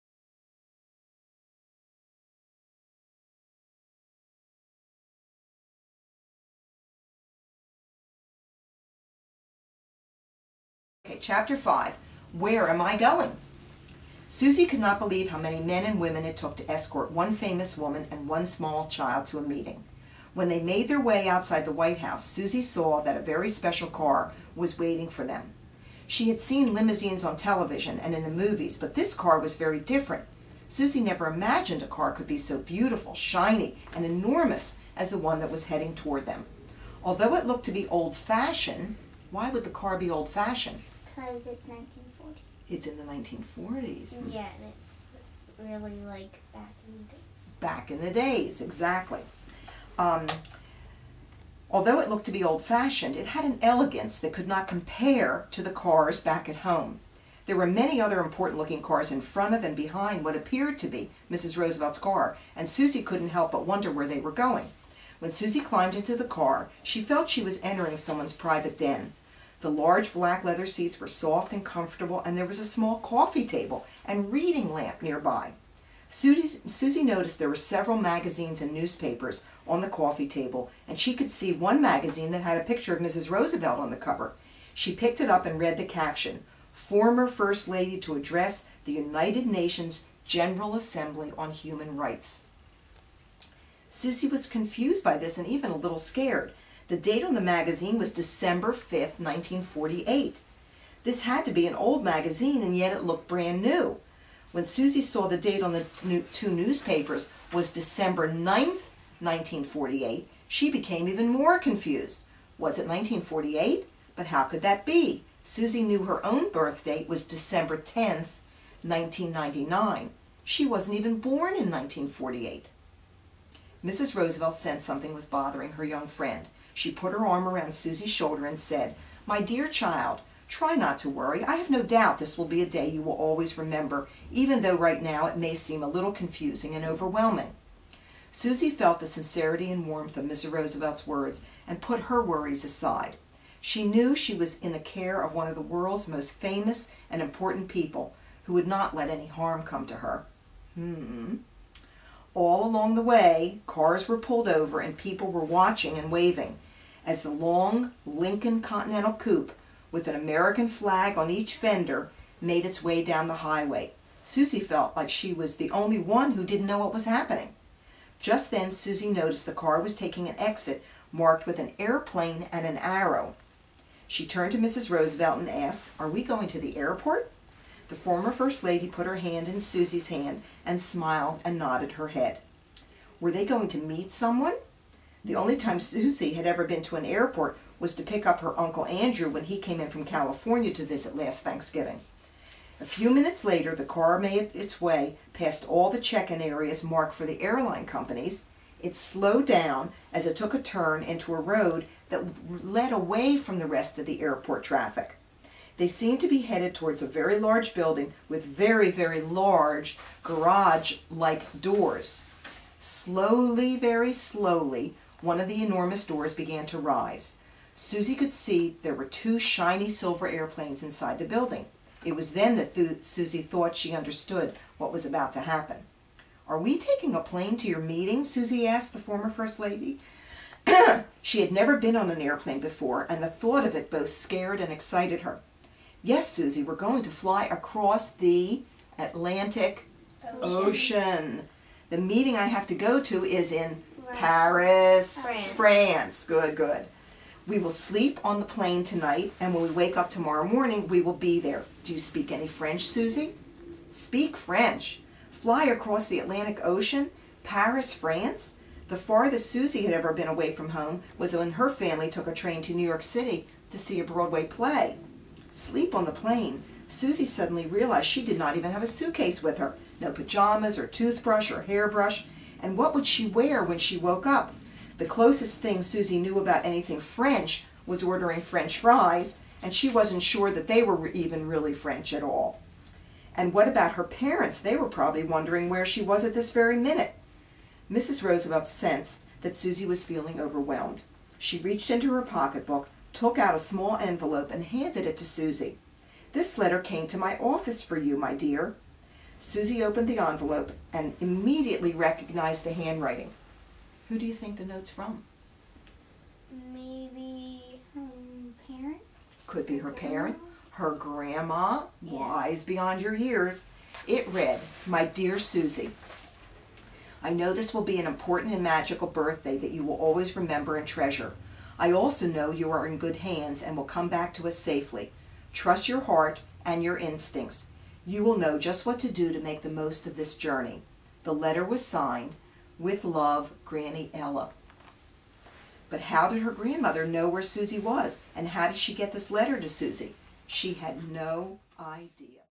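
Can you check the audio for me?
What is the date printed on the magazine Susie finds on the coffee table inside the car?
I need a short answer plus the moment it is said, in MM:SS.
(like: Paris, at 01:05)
December 5th, 1948, at 01:38.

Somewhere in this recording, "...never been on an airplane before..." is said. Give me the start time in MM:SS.
03:51.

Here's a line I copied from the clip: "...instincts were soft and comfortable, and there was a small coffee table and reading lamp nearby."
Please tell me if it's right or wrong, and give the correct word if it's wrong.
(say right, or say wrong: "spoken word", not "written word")
wrong: "seats", not "instincts".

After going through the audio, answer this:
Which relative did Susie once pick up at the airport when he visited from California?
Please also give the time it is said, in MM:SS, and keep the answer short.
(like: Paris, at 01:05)
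Uncle Andrew, at 03:08.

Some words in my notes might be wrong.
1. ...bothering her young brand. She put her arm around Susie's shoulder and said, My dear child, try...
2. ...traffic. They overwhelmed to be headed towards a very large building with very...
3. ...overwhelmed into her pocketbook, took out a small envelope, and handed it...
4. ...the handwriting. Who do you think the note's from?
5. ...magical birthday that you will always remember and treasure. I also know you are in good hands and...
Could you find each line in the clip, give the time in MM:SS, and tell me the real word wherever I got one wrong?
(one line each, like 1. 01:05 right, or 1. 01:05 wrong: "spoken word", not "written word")
1. 02:05 wrong: "friend", not "brand"
2. 03:24 wrong: "seemed", not "overwhelmed"
3. 04:51 wrong: "reached", not "overwhelmed"
4. 05:02 right
5. 05:18 right.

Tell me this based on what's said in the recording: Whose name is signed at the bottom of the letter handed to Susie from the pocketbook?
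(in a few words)
Granny Ella.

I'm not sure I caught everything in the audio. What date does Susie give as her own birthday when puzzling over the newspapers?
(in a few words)
December 10th, 1999.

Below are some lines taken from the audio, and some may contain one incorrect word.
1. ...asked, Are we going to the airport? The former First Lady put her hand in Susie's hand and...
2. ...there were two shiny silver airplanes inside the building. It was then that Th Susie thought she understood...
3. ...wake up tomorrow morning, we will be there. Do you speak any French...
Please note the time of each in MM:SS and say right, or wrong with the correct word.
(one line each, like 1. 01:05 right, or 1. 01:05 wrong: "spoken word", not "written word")
1. 02:55 right
2. 03:38 right
3. 04:09 right.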